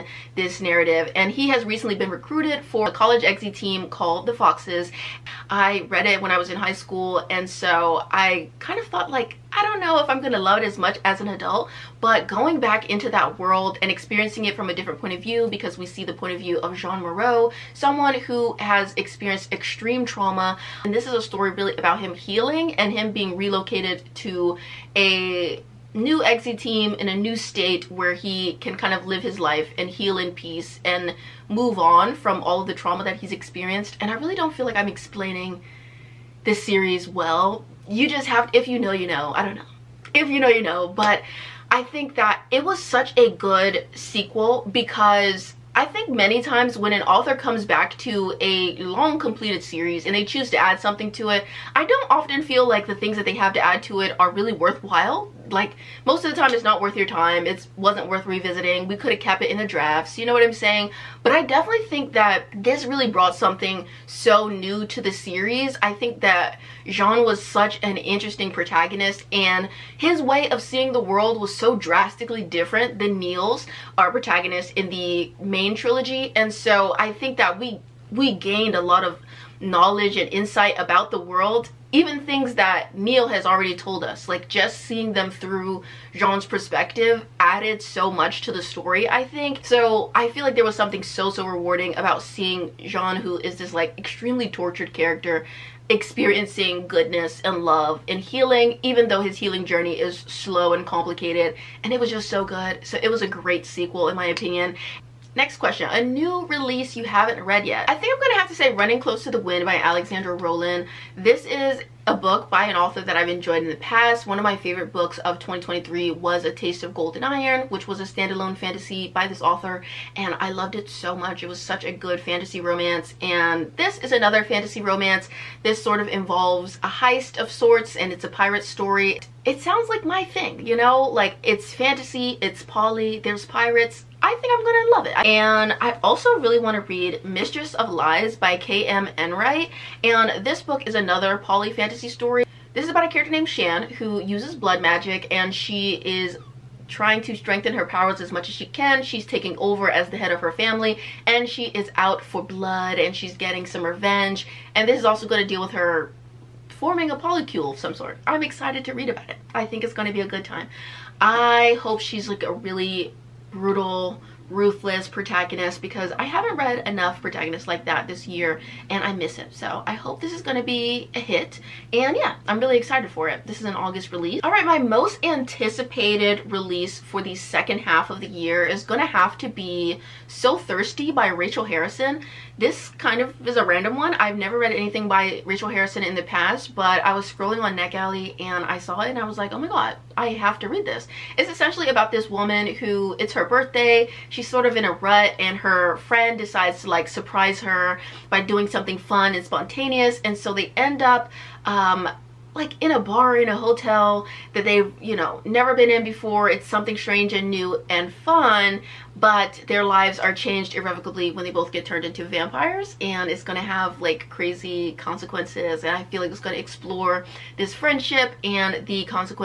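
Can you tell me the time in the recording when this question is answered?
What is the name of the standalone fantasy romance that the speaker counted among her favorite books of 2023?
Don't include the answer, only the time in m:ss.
1:56.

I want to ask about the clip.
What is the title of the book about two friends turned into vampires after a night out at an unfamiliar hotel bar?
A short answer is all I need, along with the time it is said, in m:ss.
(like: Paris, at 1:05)
So Thirsty, at 3:00.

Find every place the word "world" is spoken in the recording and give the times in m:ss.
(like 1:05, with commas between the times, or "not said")
0:13, 1:11, 1:21.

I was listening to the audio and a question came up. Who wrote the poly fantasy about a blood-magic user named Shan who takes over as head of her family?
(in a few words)
K.M. Enright.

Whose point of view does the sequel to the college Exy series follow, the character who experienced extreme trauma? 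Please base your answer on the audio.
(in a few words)
Jean Moreau.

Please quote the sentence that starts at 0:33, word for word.
And I really don't feel like I'm explaining this series well you just have, if you know, you know.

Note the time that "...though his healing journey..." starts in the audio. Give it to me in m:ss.
1:39.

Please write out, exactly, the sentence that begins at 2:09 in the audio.
It sounds like my thing, you know?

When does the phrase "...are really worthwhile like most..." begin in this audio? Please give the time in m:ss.
0:54.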